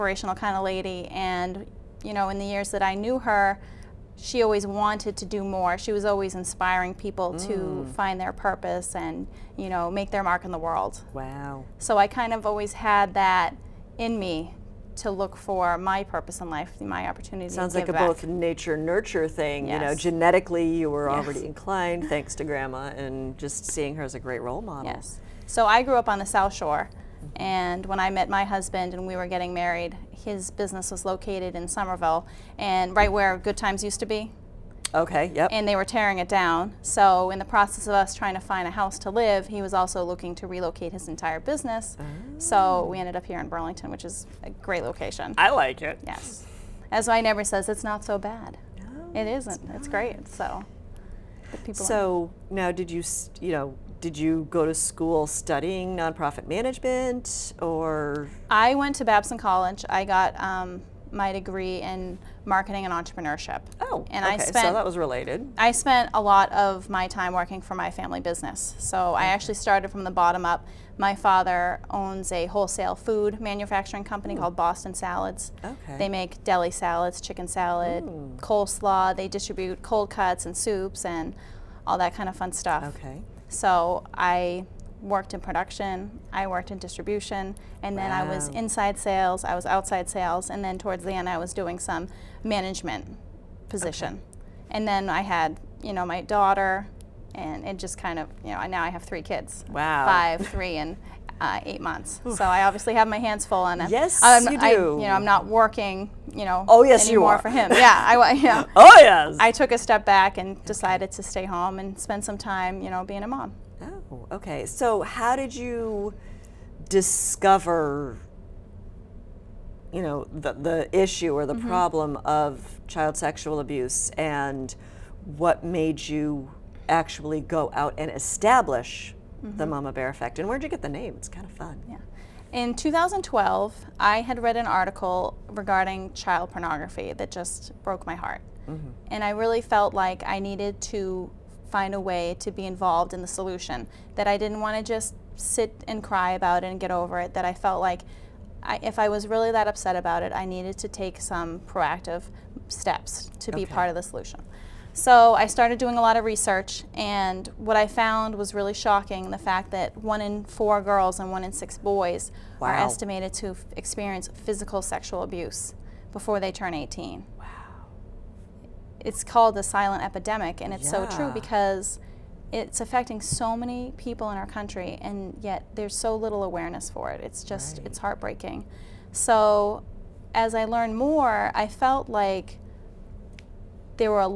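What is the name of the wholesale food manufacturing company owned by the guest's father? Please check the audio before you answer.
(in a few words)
Boston Salads.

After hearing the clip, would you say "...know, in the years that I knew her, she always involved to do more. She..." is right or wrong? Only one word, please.
wrong.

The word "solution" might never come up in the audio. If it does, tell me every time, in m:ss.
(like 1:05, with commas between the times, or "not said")
2:23, 2:34.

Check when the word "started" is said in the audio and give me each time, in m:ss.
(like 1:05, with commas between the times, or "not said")
1:09, 2:35.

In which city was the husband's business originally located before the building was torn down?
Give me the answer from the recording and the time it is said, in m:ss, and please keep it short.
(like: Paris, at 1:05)
Somerville, at 0:31.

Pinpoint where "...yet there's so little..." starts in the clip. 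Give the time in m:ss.
2:55.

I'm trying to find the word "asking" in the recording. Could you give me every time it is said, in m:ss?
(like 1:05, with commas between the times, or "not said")
not said.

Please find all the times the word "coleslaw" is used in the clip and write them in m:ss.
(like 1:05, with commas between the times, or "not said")
1:18.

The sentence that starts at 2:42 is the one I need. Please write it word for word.
are estimated to experience physical sexual abuse before they turn 18.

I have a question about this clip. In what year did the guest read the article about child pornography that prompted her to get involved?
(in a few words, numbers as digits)
2012.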